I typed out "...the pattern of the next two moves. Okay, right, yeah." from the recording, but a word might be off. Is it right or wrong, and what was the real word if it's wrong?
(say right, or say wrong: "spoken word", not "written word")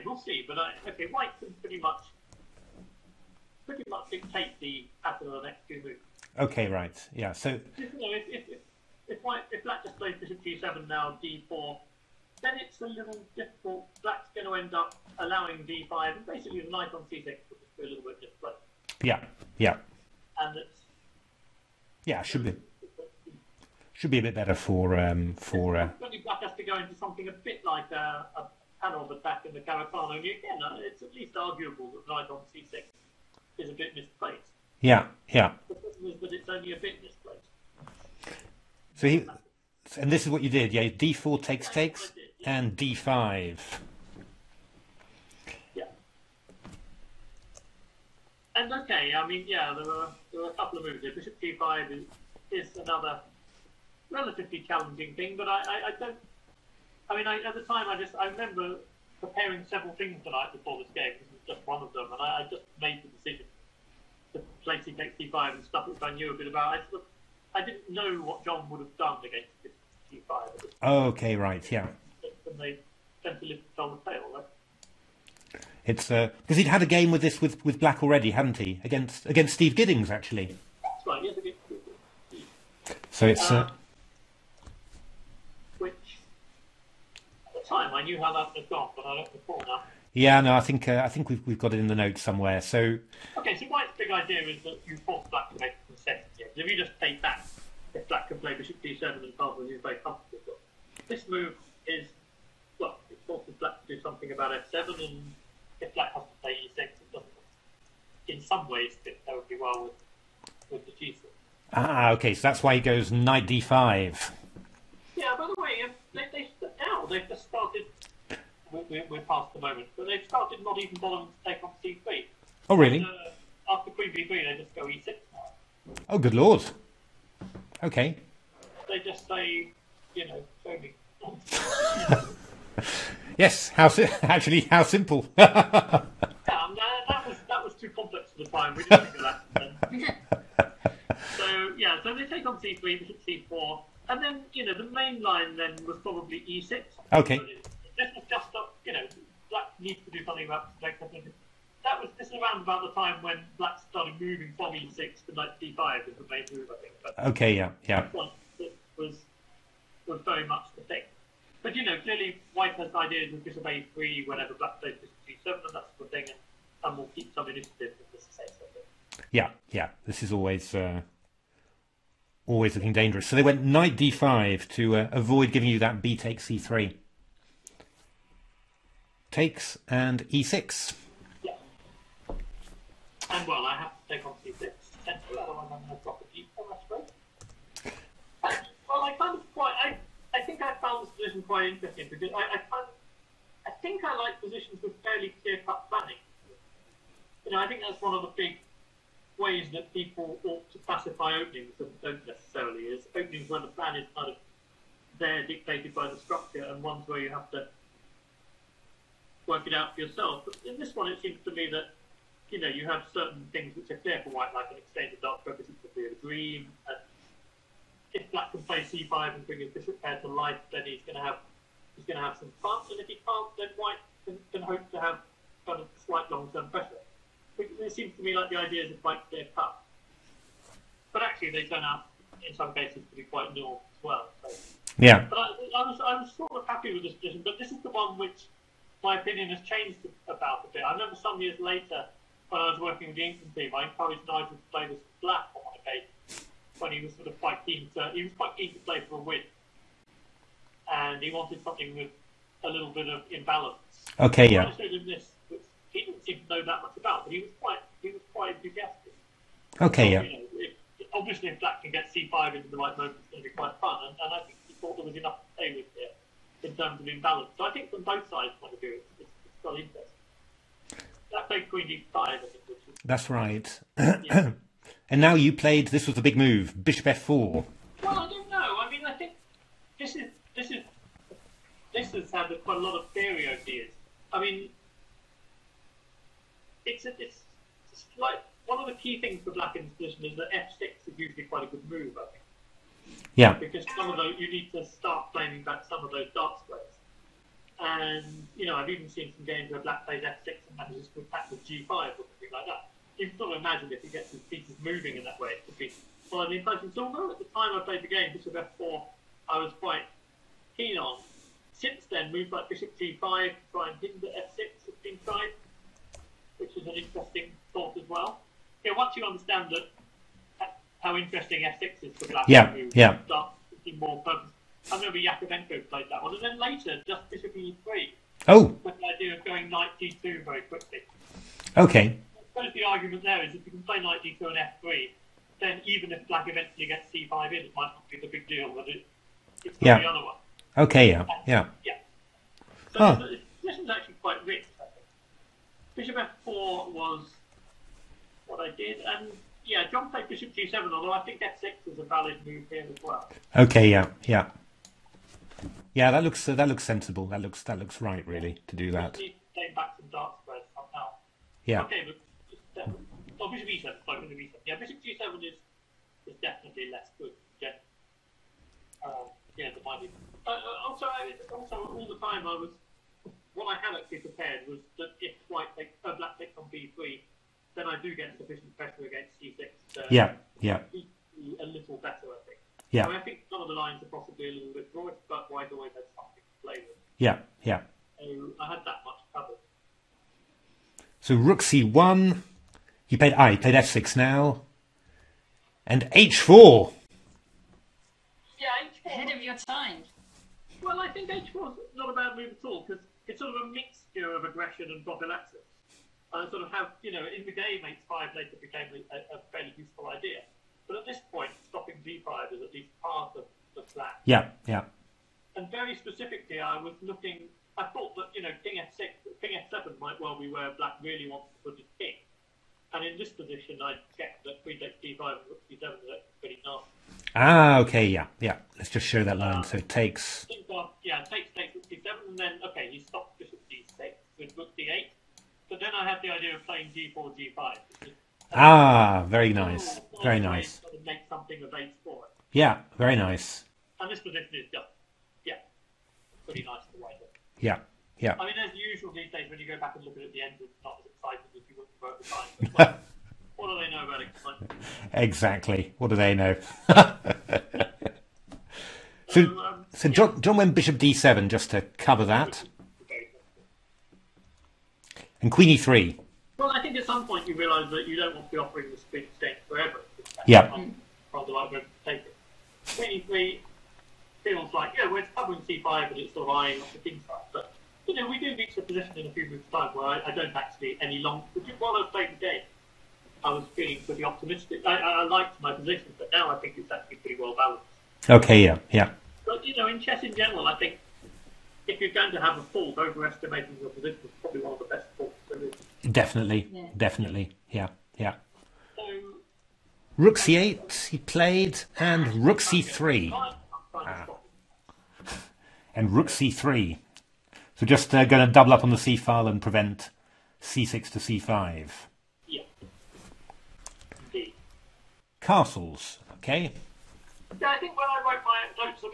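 right.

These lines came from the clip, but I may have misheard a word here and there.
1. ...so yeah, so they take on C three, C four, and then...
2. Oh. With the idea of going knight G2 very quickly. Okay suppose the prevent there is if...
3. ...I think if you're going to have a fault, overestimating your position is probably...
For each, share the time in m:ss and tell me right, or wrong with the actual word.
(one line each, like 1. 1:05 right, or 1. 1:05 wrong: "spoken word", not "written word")
1. 2:21 right
2. 5:28 wrong: "argument", not "prevent"
3. 8:10 right.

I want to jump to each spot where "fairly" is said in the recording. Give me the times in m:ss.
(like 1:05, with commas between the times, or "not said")
3:15, 6:49.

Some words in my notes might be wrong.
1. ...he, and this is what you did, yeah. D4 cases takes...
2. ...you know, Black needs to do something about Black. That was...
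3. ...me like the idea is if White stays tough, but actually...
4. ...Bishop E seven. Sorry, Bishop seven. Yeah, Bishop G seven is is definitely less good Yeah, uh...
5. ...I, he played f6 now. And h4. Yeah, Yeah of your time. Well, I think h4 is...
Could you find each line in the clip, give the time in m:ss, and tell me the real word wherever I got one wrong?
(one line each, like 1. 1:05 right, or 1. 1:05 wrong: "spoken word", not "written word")
1. 0:39 wrong: "takes", not "cases"
2. 2:28 right
3. 3:48 right
4. 6:03 right
5. 6:33 wrong: "Ahead", not "Yeah".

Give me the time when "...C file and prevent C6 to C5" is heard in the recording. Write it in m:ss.
8:28.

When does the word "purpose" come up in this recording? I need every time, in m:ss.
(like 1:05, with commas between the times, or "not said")
3:35, 5:24.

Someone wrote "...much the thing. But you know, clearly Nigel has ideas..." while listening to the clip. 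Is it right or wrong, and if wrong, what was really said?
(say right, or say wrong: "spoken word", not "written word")
wrong: "White", not "Nigel".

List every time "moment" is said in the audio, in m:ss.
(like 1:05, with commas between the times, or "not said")
1:59, 4:22.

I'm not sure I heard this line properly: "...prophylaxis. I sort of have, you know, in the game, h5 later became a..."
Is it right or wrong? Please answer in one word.
right.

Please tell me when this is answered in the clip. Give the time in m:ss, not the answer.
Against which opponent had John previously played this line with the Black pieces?
1:19.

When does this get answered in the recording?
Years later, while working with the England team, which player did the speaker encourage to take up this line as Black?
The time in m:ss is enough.
4:04.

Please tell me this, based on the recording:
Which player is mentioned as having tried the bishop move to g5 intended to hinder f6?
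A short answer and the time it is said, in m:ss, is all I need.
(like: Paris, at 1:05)
Yakovenko, at 5:25.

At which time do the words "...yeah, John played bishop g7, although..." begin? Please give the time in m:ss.
5:49.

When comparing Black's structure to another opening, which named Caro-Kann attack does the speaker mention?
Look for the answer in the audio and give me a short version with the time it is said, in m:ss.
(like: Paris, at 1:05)
Panov attack, at 0:28.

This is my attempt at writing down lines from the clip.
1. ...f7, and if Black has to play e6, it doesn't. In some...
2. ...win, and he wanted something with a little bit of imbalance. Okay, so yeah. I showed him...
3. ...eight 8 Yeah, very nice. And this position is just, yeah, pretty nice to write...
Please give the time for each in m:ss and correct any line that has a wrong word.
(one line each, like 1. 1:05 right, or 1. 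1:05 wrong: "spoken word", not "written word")
1. 1:44 right
2. 4:09 right
3. 7:21 wrong: "4", not "8".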